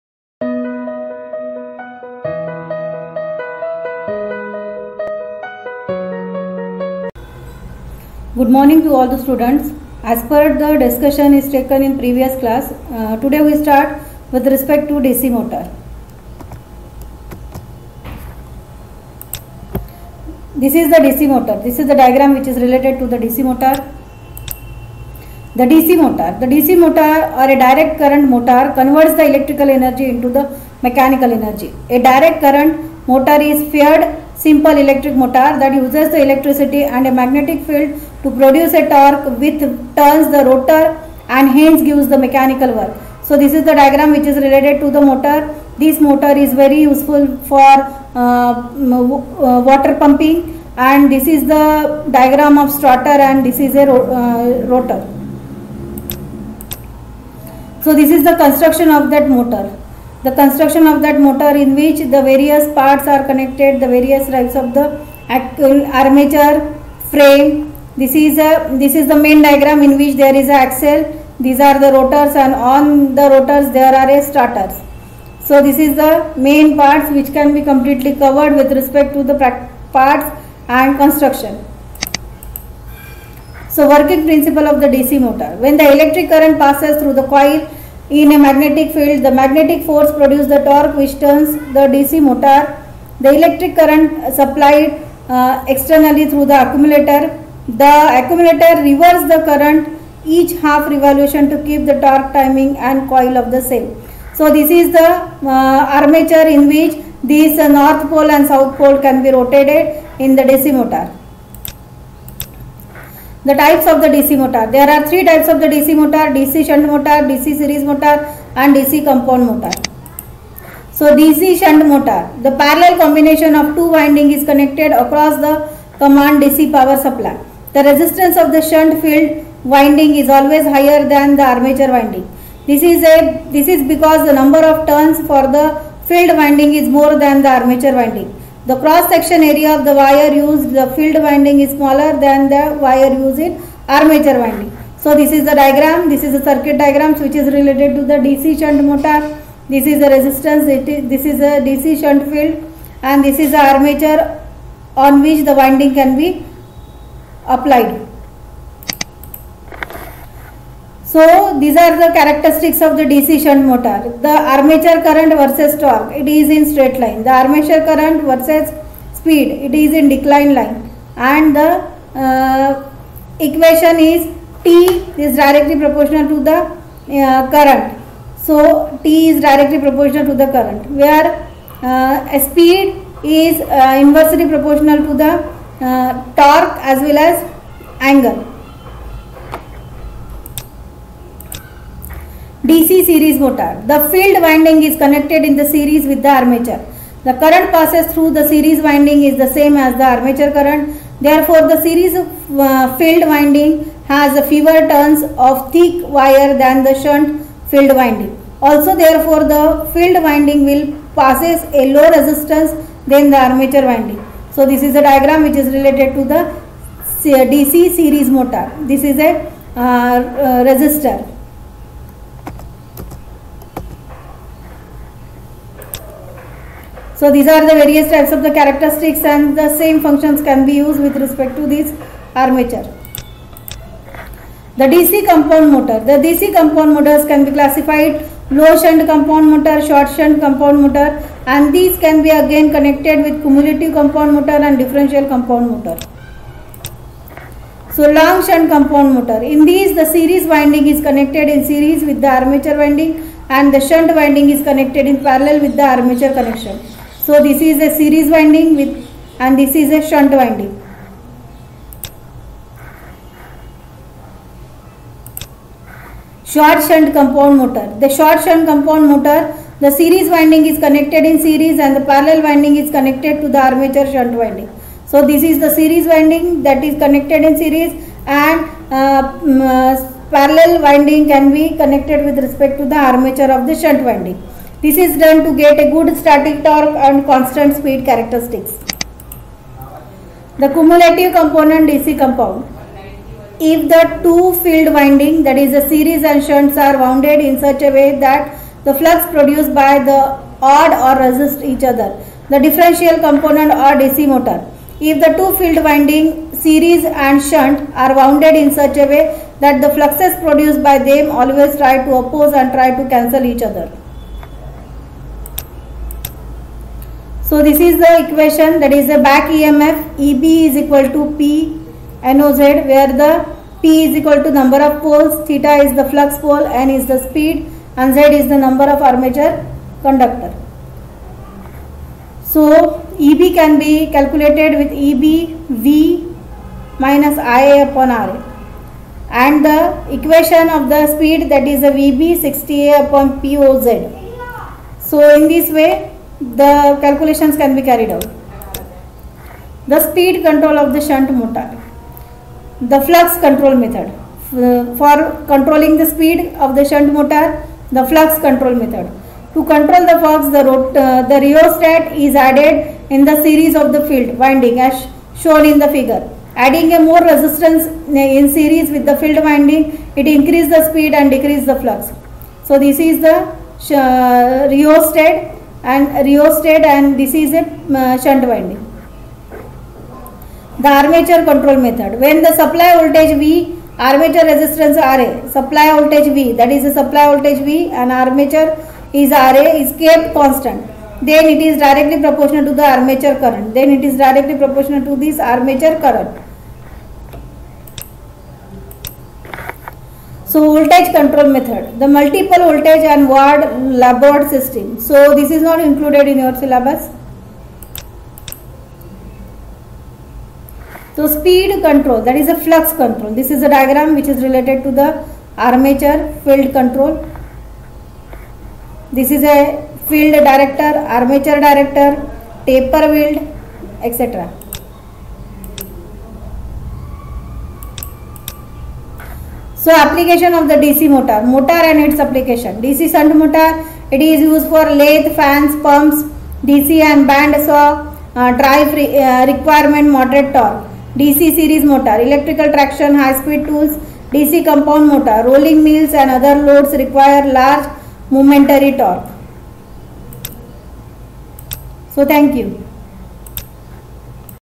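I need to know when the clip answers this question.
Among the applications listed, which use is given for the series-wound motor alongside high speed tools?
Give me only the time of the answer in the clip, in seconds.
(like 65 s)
442 s.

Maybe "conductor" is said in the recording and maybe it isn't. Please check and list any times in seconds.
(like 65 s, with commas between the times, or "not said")
330 s.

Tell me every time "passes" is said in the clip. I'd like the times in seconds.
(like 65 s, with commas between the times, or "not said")
86 s, 197 s, 211 s.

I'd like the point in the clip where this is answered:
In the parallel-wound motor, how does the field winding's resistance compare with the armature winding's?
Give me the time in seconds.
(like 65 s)
130 s.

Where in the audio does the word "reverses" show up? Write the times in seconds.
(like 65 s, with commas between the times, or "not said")
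98 s.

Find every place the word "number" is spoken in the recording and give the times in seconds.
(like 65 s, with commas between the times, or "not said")
134 s, 324 s, 328 s.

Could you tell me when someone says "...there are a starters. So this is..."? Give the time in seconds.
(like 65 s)
73 s.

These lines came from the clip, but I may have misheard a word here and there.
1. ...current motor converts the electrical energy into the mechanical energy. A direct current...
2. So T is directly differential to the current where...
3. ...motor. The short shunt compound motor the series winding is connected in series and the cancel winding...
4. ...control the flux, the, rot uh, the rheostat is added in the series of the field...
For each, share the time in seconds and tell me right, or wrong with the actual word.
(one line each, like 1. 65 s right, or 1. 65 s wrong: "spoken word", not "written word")
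1. 28 s right
2. 178 s wrong: "proportional", not "differential"
3. 267 s wrong: "parallel", not "cancel"
4. 359 s right.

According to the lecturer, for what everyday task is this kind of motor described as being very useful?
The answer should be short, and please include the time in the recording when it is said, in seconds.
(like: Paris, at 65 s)
water pumping, at 49 s.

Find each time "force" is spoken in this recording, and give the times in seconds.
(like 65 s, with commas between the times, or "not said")
89 s.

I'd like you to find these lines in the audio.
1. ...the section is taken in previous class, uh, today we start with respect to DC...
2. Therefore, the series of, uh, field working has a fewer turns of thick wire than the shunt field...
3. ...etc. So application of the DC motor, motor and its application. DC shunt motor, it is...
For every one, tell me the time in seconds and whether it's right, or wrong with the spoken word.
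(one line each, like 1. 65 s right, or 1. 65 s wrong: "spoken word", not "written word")
1. 10 s wrong: "discussion", not "section"
2. 201 s wrong: "winding", not "working"
3. 424 s right.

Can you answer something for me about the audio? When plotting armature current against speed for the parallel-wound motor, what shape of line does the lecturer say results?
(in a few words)
decline line.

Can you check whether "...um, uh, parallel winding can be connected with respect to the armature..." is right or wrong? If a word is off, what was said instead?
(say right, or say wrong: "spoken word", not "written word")
right.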